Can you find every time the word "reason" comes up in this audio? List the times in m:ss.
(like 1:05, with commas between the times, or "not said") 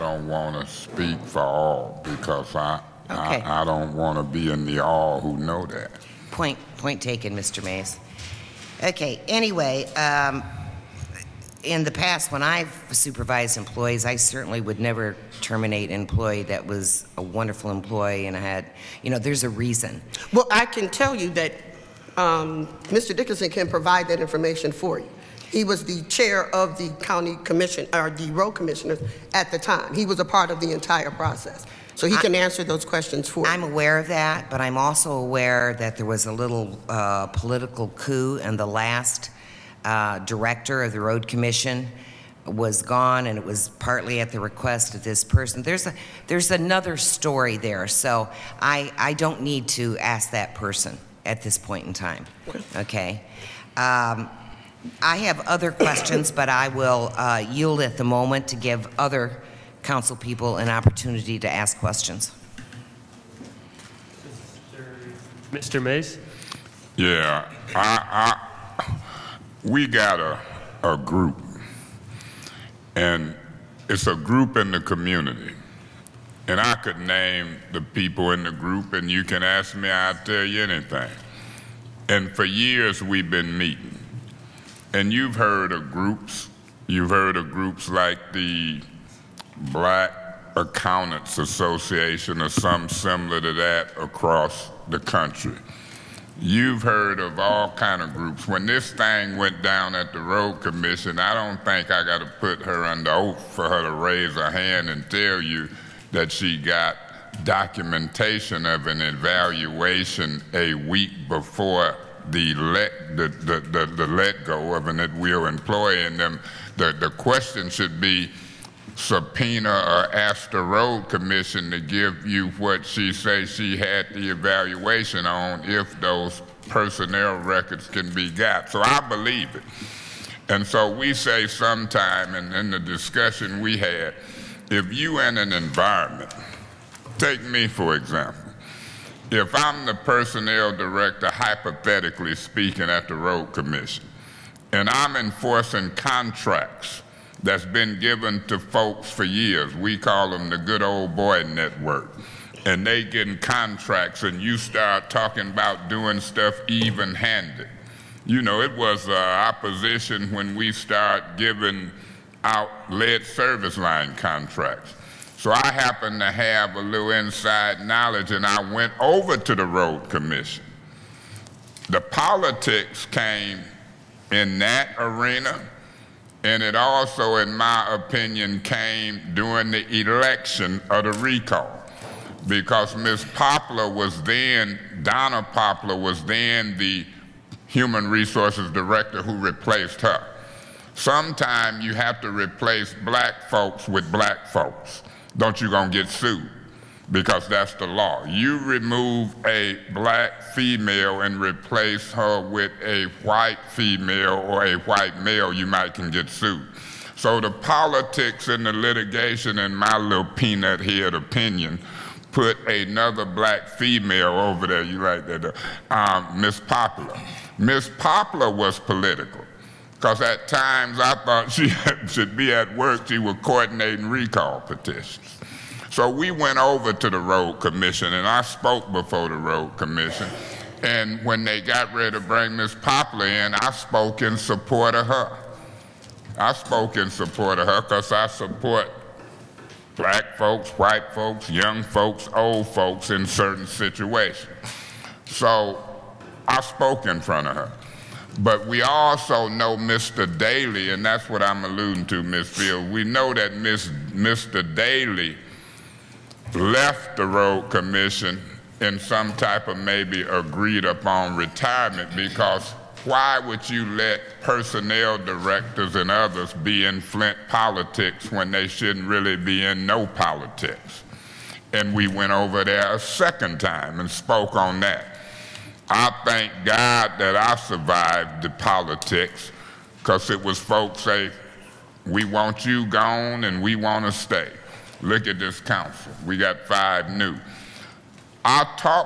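0:19.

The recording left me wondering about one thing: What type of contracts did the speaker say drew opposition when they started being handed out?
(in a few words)
lead service line contracts.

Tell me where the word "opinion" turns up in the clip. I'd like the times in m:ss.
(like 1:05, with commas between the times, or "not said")
2:57, 3:31.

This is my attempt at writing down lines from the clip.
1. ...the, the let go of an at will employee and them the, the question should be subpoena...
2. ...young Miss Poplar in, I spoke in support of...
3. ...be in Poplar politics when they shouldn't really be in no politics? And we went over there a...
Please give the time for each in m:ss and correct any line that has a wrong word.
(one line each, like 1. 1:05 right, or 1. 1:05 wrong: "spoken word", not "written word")
1. 1:53 right
2. 3:52 wrong: "bring", not "young"
3. 4:26 wrong: "Flint", not "Poplar".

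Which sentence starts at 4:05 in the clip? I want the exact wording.
So I spoke in front of her.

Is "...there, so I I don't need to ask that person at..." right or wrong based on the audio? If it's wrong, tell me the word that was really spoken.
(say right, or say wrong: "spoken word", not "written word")
right.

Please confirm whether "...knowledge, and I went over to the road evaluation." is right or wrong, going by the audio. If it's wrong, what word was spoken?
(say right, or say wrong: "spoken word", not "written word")
wrong: "commission", not "evaluation".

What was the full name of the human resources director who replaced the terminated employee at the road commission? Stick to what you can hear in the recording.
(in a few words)
Donna Poplar.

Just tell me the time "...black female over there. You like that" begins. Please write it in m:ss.
3:33.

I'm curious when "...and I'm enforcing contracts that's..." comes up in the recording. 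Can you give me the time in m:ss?
2:24.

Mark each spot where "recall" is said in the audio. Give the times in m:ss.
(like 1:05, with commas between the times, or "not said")
3:01, 3:44.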